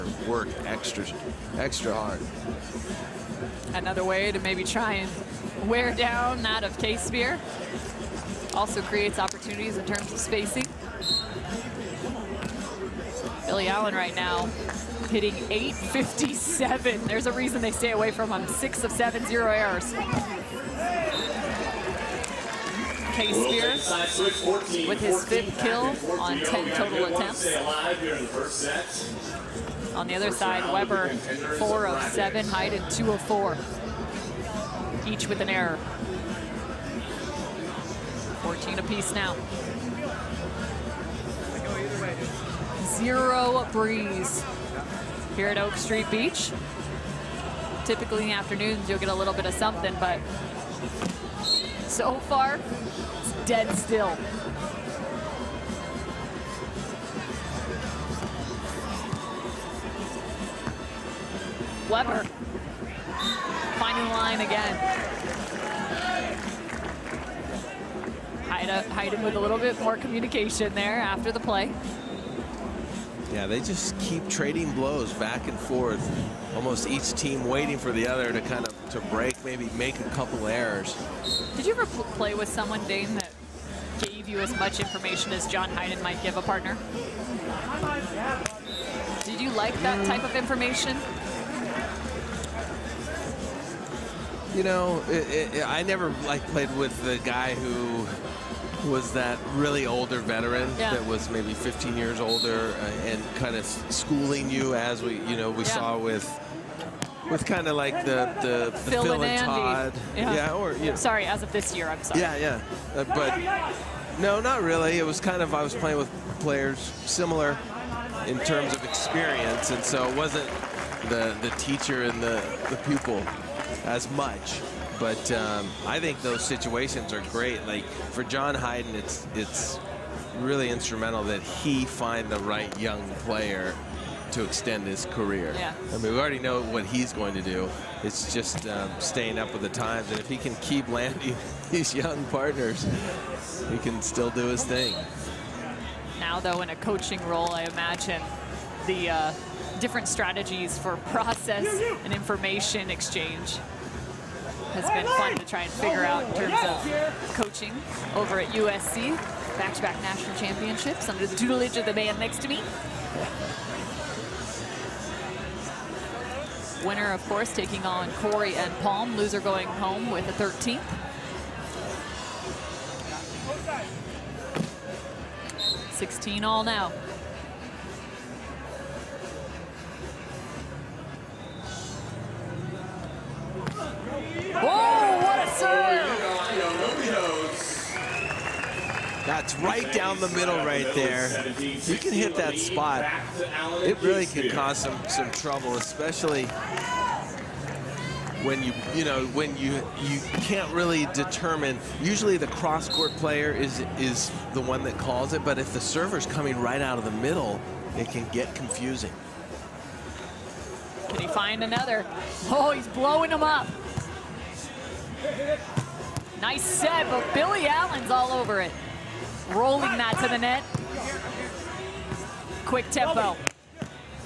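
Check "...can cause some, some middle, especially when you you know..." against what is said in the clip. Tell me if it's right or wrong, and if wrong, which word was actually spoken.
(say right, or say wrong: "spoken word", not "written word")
wrong: "trouble", not "middle".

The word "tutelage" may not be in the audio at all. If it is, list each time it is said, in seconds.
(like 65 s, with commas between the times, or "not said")
161 s.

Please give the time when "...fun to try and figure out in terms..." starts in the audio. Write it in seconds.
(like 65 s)
155 s.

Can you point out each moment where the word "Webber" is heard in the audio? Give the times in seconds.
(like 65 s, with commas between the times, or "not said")
30 s, 61 s.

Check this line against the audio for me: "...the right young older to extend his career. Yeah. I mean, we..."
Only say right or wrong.
wrong.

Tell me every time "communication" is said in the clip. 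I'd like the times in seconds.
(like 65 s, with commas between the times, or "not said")
69 s.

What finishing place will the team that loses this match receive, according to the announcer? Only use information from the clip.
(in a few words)
13th.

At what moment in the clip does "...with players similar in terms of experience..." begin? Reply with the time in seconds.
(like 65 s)
115 s.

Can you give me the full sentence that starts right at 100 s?
that was maybe 15 years older uh, and kind of schooling you as we, you know, we yeah.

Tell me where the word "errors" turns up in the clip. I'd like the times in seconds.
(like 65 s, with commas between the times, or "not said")
19 s, 35 s, 80 s.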